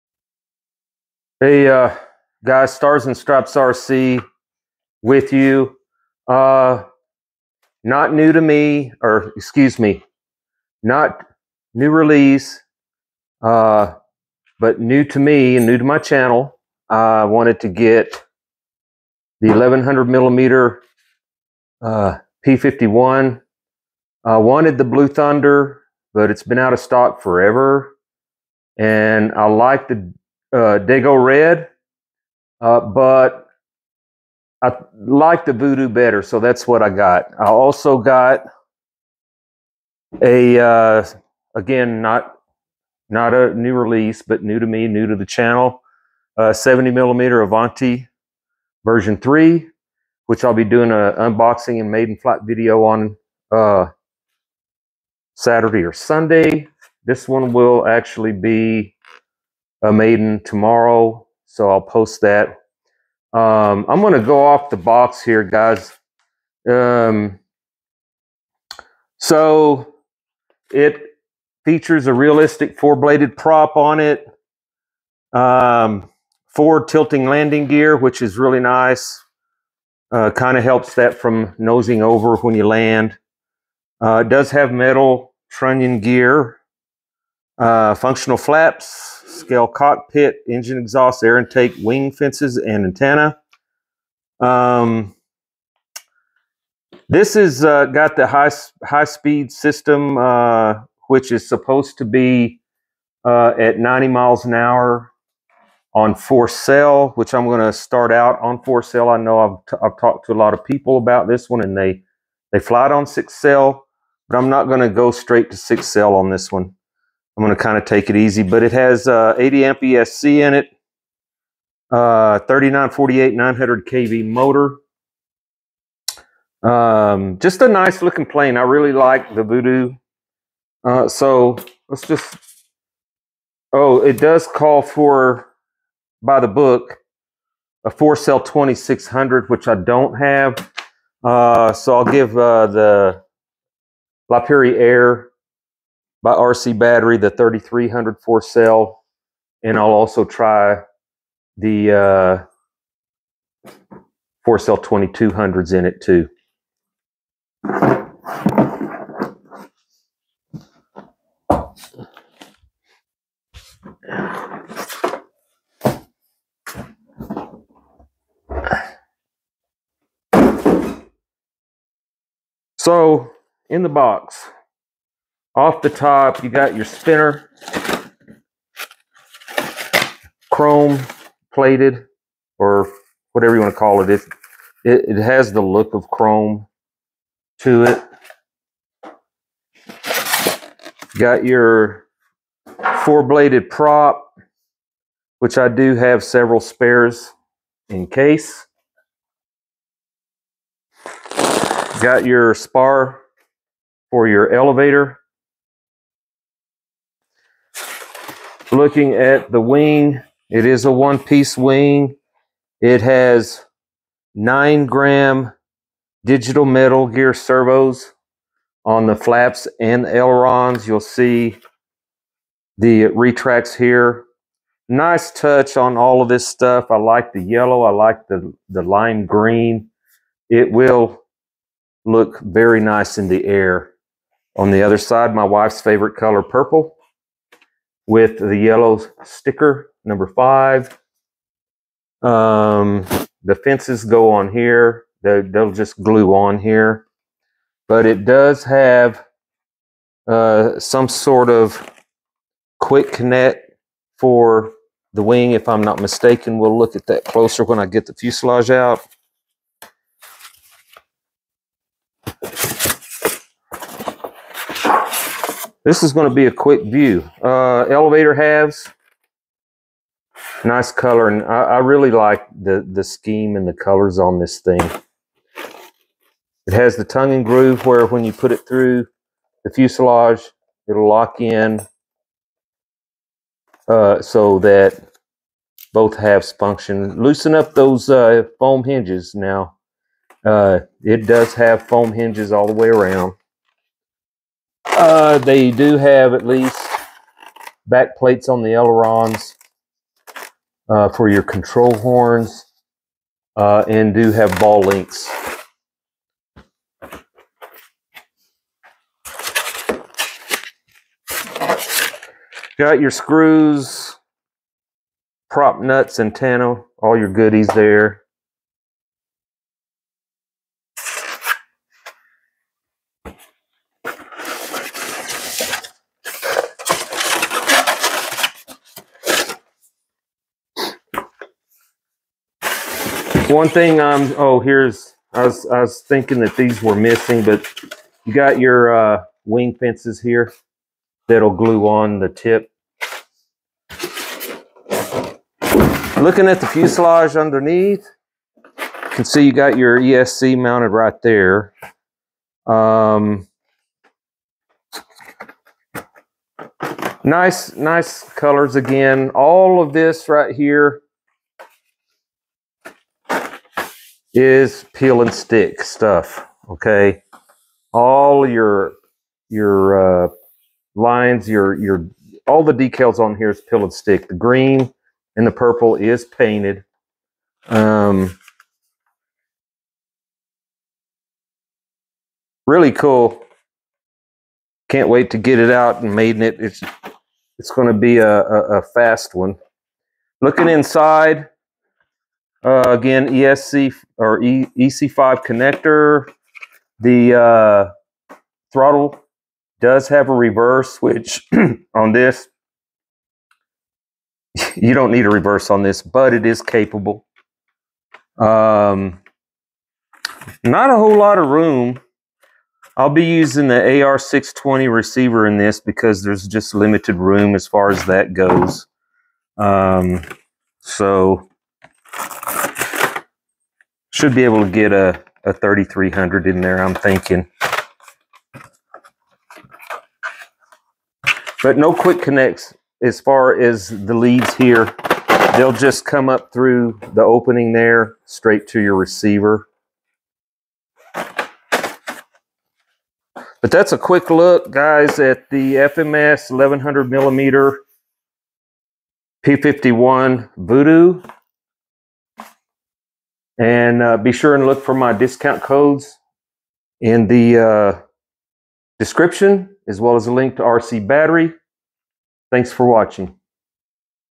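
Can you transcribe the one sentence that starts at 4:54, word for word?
Uh, they do have at least back plates on the ailerons uh, for your control horns uh, and do have ball links.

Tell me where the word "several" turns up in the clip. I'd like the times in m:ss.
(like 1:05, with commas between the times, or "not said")
3:16.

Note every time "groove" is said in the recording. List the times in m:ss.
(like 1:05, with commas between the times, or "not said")
4:37.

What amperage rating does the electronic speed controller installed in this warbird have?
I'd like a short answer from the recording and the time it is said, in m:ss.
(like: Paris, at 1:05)
80 amp, at 1:59.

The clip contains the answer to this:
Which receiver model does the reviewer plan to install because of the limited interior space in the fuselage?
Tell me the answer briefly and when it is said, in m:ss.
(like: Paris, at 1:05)
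AR620, at 6:53.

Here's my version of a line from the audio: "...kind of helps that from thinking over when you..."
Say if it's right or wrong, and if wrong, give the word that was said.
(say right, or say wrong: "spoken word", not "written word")
wrong: "nosing", not "thinking".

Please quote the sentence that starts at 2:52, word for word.
So in the box, off the top, you got your spinner, chrome plated, or whatever you want to call it.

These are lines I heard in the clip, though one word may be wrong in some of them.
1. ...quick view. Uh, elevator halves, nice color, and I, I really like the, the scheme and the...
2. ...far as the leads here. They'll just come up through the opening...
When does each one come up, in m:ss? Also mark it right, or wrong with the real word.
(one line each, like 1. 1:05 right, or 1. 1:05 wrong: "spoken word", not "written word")
1. 4:26 right
2. 7:13 right.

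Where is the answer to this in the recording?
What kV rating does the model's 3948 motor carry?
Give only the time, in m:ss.
2:03.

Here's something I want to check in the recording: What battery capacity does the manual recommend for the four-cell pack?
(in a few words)
2600.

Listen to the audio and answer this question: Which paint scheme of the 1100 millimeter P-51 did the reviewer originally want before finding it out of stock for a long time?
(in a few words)
Blue Thunder.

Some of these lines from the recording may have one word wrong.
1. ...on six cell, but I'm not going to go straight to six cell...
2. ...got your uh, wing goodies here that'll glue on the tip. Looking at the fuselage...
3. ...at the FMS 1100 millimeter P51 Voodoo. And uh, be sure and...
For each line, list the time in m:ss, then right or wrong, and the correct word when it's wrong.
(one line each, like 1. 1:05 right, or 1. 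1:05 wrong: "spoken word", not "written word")
1. 1:52 right
2. 5:38 wrong: "fences", not "goodies"
3. 7:25 right.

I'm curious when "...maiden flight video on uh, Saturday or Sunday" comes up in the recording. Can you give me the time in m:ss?
0:51.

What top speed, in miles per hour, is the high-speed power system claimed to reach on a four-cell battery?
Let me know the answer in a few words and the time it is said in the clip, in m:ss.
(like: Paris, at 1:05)
90, at 1:43.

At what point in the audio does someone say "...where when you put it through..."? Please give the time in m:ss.
4:37.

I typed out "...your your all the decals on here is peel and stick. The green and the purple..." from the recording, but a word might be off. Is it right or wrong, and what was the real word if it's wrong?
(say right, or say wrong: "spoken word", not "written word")
right.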